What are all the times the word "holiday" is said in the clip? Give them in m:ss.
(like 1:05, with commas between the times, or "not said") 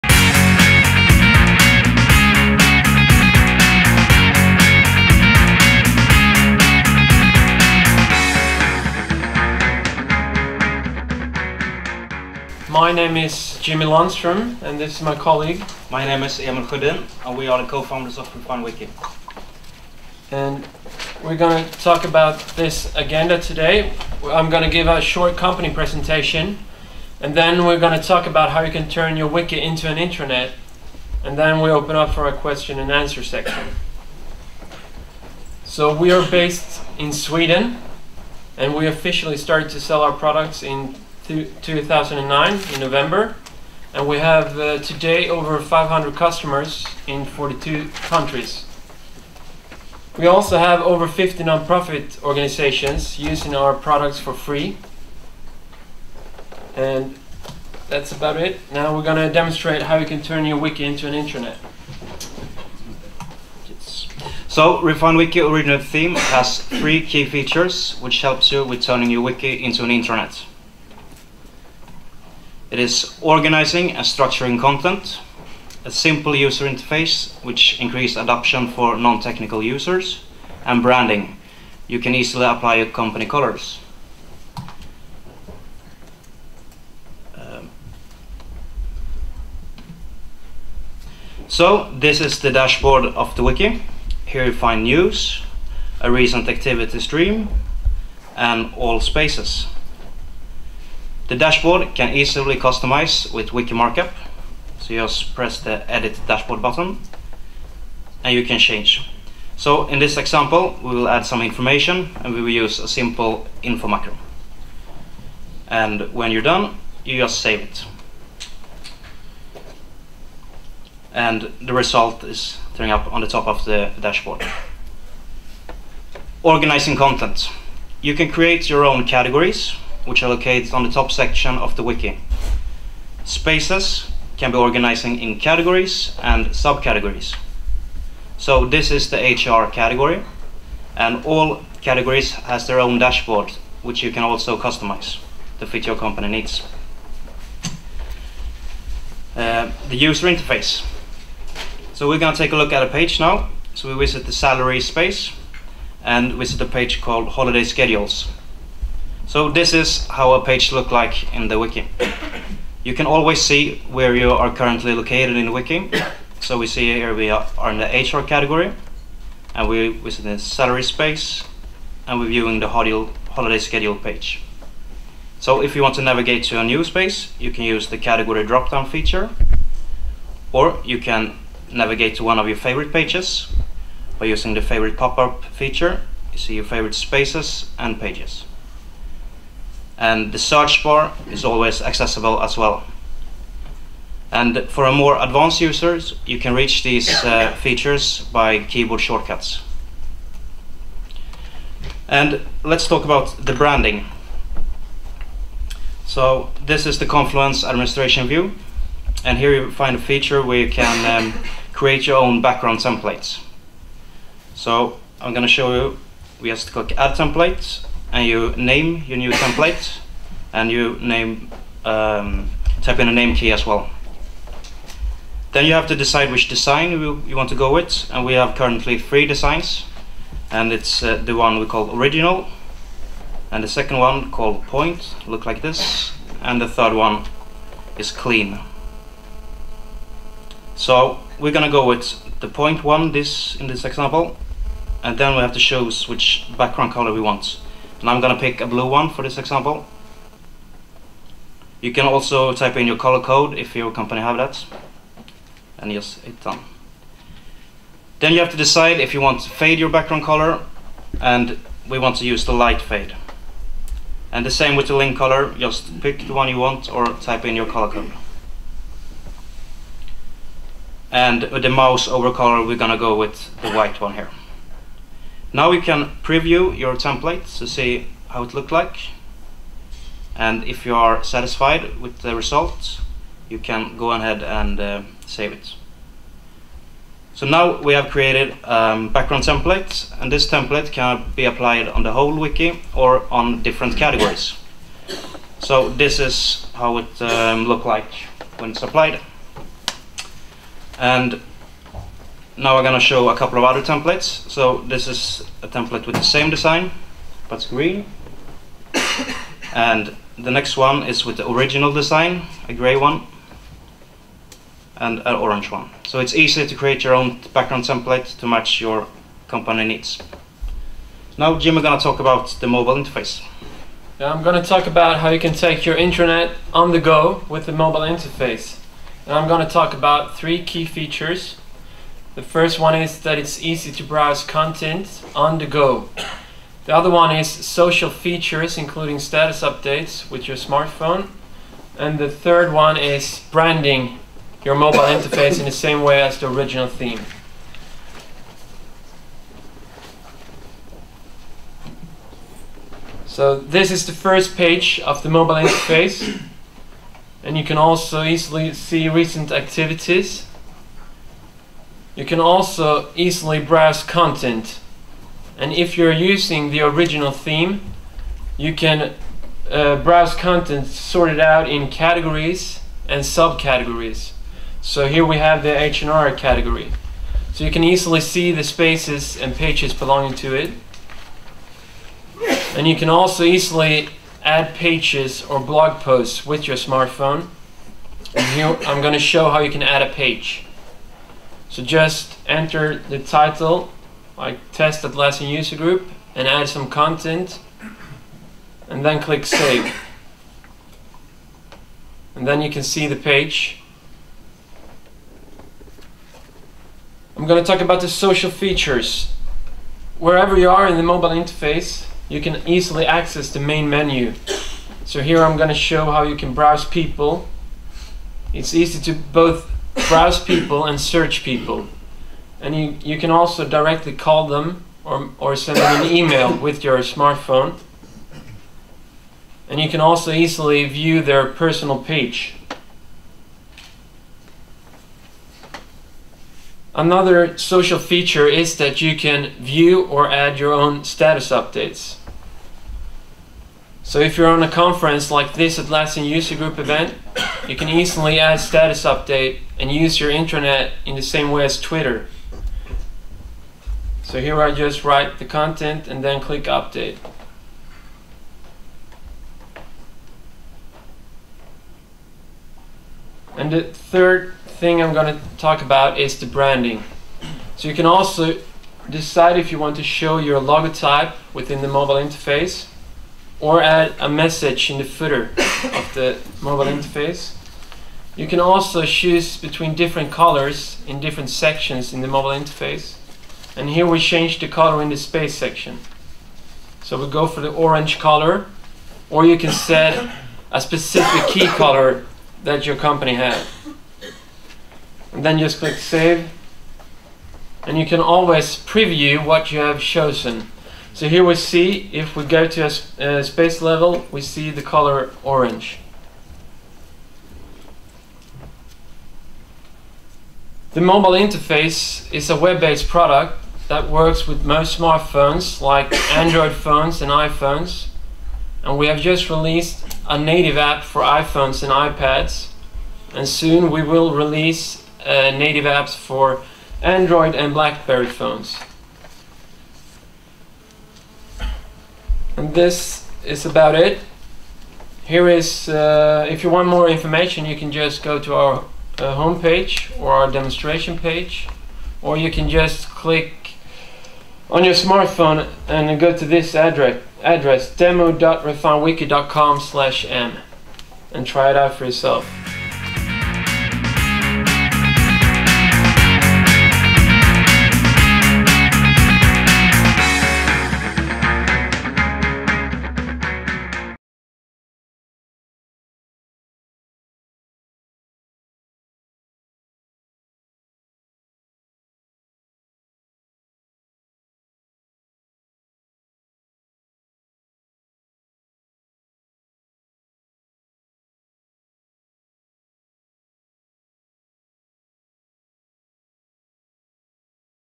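2:37, 2:52.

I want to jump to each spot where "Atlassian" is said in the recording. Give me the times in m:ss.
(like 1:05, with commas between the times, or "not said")
6:35, 7:25.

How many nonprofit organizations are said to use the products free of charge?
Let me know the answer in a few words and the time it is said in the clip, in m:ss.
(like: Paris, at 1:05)
over 50, at 0:50.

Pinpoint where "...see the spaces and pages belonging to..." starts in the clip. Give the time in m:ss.
6:18.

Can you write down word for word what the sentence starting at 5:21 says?
Now Jim is gonna talk about the mobile interface.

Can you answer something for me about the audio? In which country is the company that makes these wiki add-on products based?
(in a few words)
Sweden.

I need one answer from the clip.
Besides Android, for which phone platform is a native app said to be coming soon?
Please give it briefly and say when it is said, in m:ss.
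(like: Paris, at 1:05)
BlackBerry, at 8:47.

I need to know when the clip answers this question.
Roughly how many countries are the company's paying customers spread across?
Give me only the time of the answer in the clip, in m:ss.
0:47.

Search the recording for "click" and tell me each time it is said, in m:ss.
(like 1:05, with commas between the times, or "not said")
3:36, 6:39, 7:36, 8:15, 9:03.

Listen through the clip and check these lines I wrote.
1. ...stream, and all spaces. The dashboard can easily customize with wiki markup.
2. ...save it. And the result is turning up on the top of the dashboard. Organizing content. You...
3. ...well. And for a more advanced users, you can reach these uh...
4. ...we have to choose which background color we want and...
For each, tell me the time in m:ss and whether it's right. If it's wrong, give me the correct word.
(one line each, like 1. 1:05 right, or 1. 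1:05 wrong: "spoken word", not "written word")
1. 1:37 right
2. 1:57 right
3. 3:12 right
4. 4:05 right.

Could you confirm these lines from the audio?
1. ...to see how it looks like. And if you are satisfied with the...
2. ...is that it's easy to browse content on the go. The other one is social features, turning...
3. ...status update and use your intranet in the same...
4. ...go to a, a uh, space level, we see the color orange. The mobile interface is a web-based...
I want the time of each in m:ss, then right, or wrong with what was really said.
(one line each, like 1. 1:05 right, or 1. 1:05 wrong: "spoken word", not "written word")
1. 4:37 right
2. 5:32 wrong: "including", not "turning"
3. 7:28 right
4. 8:22 right.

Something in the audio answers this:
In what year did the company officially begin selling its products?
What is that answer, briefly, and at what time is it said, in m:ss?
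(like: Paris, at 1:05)
2009, at 0:41.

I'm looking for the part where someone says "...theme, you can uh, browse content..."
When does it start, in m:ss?
6:07.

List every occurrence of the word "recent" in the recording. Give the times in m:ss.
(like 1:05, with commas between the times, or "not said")
1:36, 5:59.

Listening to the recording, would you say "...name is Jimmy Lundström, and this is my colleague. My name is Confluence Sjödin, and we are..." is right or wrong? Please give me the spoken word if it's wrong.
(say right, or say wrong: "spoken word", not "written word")
wrong: "Emil", not "Confluence".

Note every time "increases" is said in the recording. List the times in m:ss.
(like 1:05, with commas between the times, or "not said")
1:17.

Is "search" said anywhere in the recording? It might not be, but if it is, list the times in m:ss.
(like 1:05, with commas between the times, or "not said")
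3:10, 7:00.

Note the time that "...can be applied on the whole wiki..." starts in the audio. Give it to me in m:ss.
4:50.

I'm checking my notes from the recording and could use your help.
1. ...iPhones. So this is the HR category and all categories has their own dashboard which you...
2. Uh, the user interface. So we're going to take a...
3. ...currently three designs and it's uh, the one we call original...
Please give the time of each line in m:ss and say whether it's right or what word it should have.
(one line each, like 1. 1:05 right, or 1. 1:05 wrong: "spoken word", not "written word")
1. 2:16 wrong: "subcategories", not "iPhones"
2. 2:29 right
3. 3:48 right.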